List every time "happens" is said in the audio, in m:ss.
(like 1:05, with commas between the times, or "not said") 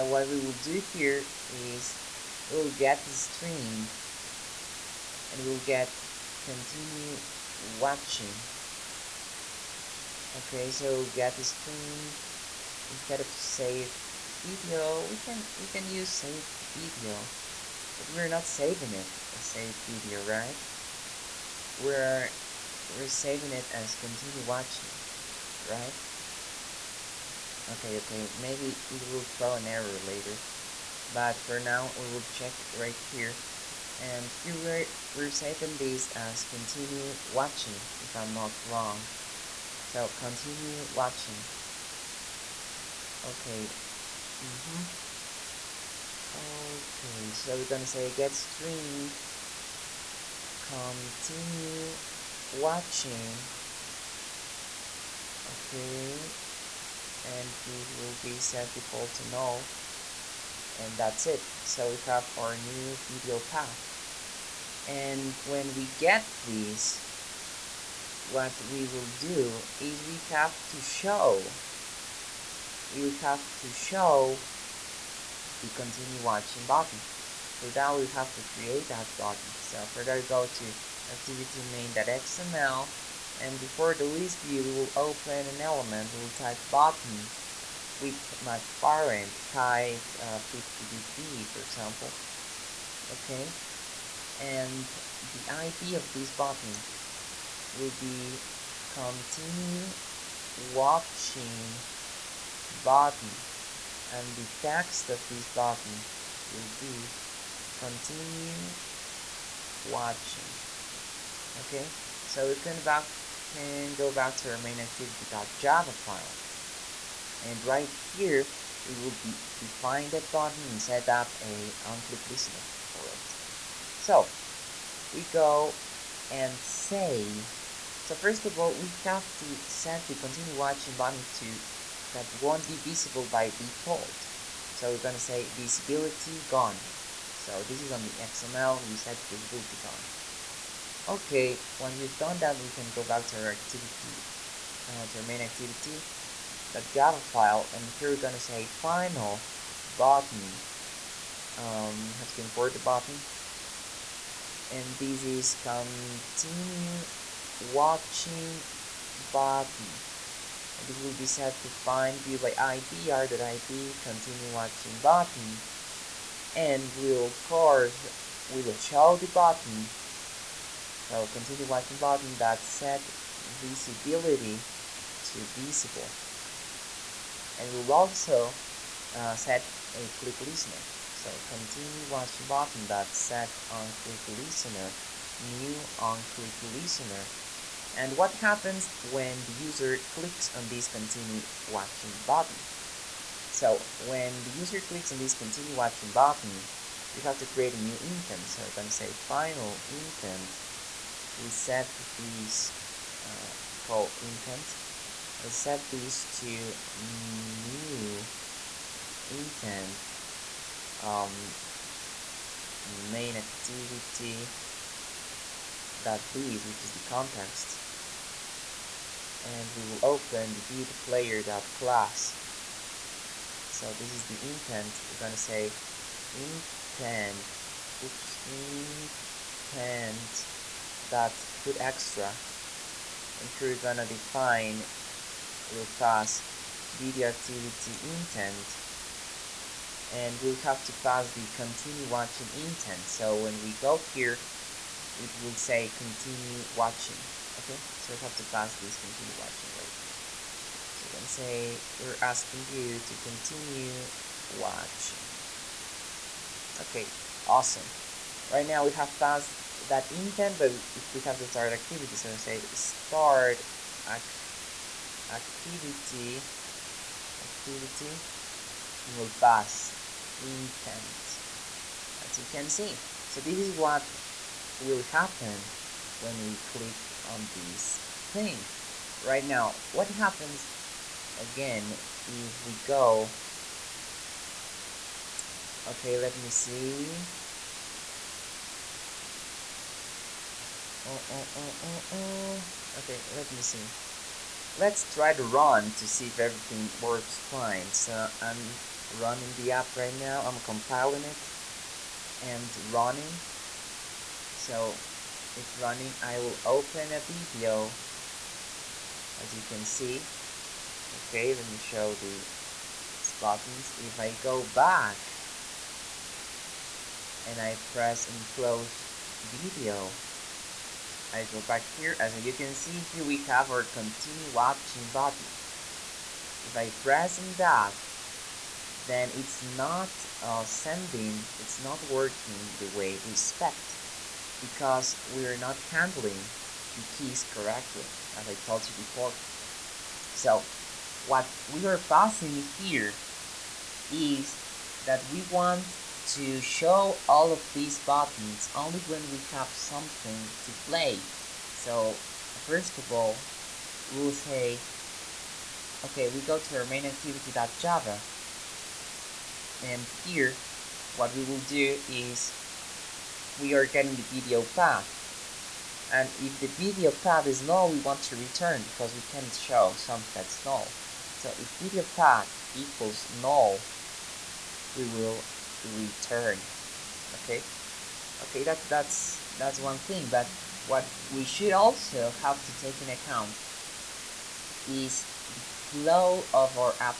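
3:08, 4:35, 4:40.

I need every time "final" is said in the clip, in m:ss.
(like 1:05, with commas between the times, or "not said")
2:28, 3:19.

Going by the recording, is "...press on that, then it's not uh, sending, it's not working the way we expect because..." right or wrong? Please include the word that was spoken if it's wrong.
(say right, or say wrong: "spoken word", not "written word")
right.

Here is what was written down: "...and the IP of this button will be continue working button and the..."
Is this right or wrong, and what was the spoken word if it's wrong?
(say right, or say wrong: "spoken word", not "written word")
wrong: "watching", not "working".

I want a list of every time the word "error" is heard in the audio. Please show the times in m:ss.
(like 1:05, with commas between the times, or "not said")
0:29.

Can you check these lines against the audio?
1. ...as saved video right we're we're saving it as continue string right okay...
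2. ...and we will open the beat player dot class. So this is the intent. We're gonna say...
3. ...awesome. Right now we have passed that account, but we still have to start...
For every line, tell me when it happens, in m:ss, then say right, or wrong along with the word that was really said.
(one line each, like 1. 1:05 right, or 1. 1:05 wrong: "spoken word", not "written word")
1. 0:19 wrong: "watching", not "string"
2. 3:39 right
3. 4:17 wrong: "intent", not "account".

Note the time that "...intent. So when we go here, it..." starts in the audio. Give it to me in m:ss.
4:02.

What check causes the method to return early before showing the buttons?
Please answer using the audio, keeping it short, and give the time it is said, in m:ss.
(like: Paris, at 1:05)
video path equals null, at 6:11.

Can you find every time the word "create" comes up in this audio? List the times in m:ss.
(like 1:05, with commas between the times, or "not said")
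1:18, 3:17.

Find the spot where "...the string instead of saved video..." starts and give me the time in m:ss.
0:11.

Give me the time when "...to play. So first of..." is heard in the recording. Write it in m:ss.
5:50.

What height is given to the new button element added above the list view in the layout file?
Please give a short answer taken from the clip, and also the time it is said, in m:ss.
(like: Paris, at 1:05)
50dp, at 1:30.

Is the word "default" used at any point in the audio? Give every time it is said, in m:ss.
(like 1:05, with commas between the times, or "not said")
0:58, 2:13.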